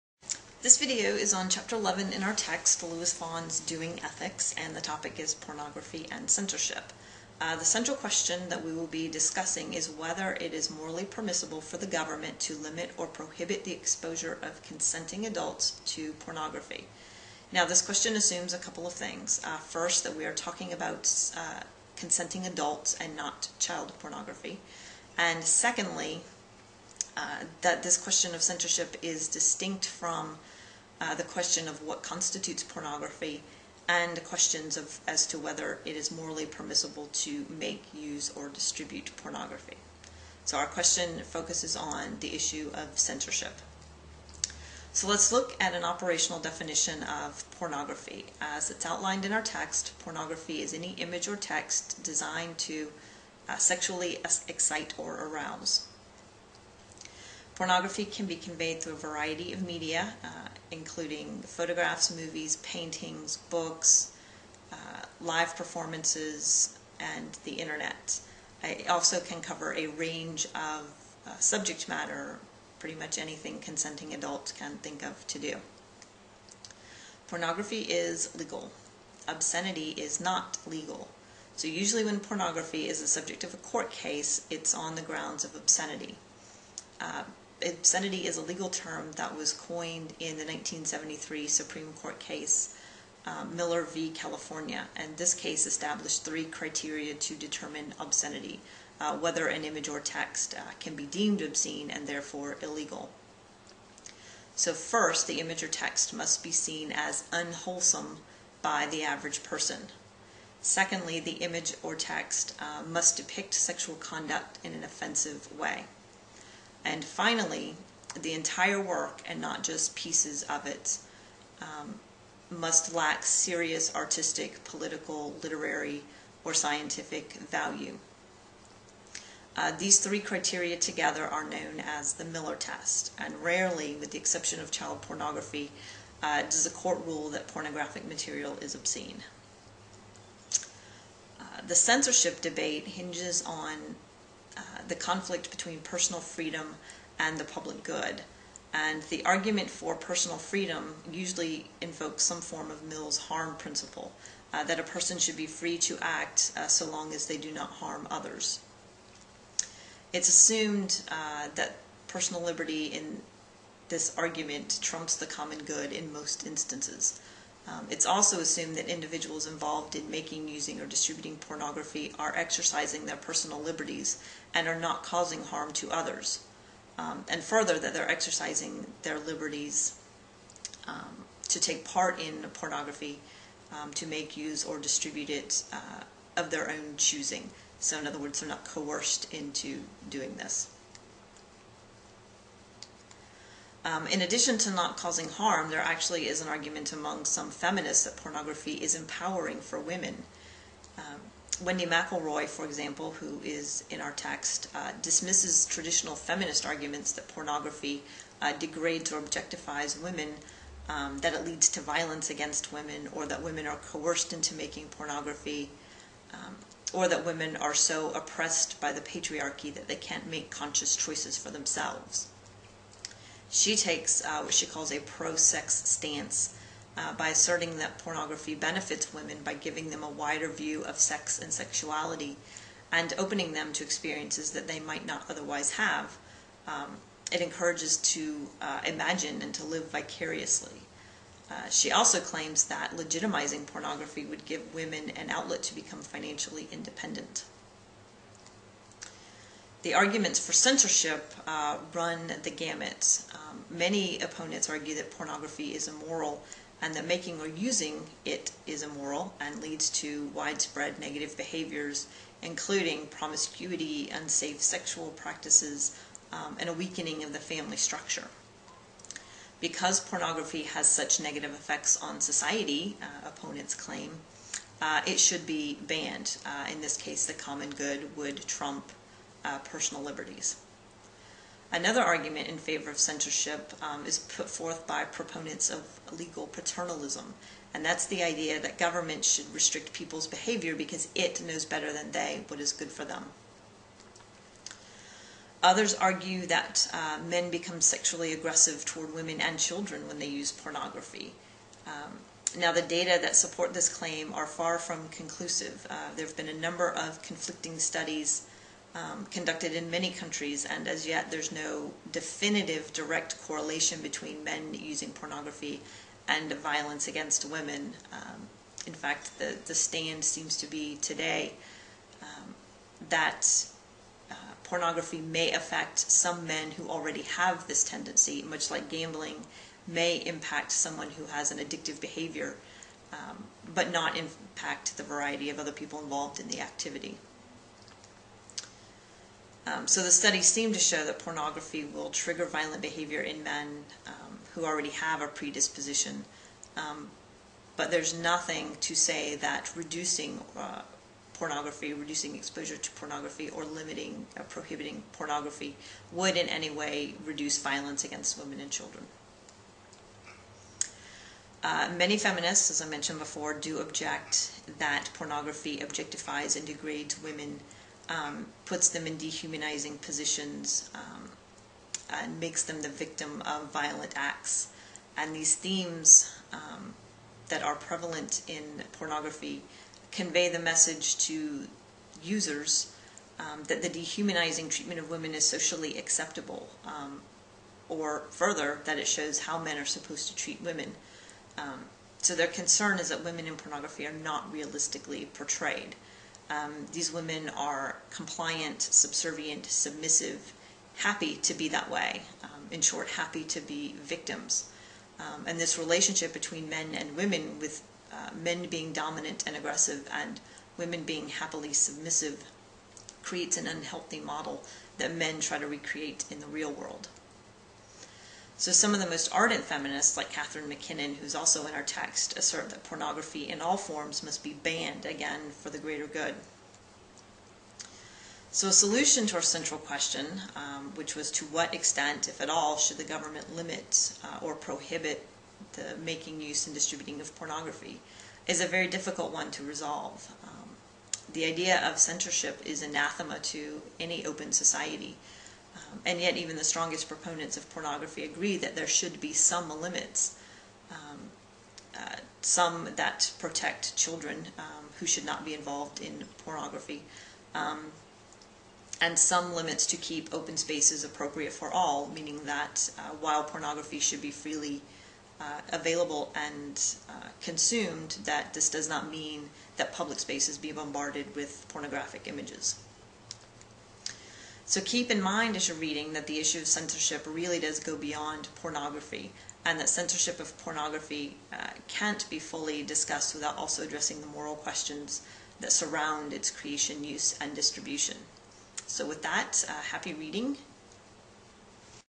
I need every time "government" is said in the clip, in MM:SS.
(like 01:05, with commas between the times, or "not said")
00:11, 04:48, 07:13.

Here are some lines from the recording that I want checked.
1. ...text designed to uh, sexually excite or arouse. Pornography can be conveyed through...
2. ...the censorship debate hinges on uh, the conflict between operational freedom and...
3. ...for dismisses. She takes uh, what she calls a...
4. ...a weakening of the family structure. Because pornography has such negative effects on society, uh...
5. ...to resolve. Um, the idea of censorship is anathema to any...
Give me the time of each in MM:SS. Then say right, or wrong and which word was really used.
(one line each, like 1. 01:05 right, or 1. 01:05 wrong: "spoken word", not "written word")
1. 00:51 right
2. 02:21 wrong: "personal", not "operational"
3. 03:41 wrong: "themselves", not "dismisses"
4. 04:26 right
5. 07:19 right.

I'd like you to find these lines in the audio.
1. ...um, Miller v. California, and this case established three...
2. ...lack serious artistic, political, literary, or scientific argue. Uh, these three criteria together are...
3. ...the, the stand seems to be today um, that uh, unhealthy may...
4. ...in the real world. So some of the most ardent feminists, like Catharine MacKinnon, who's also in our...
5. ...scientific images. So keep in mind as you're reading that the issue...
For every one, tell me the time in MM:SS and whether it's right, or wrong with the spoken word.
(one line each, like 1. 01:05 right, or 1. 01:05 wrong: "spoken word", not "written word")
1. 01:33 right
2. 02:02 wrong: "value", not "argue"
3. 05:19 wrong: "pornography", not "unhealthy"
4. 06:56 right
5. 07:51 wrong: "pornographic", not "scientific".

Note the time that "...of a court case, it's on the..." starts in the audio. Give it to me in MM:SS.
01:23.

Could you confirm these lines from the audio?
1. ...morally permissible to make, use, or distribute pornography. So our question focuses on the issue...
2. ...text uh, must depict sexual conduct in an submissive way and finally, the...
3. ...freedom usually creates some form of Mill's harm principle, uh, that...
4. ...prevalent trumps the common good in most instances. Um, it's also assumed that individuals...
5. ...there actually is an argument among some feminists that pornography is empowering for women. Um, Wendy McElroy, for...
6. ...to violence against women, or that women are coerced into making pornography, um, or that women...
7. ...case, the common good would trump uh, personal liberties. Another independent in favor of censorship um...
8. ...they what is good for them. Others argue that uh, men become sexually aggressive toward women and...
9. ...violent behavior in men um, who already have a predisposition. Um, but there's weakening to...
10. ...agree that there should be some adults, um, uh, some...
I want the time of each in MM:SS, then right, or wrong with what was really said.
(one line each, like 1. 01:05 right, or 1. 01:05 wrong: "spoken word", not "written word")
1. 00:36 right
2. 01:51 wrong: "offensive", not "submissive"
3. 02:30 wrong: "invokes", not "creates"
4. 02:44 wrong: "argument", not "prevalent"
5. 03:15 right
6. 03:31 right
7. 04:36 wrong: "argument", not "independent"
8. 04:52 right
9. 05:42 wrong: "nothing", not "weakening"
10. 07:28 wrong: "limits", not "adults".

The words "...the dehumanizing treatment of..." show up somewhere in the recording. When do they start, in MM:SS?
06:23.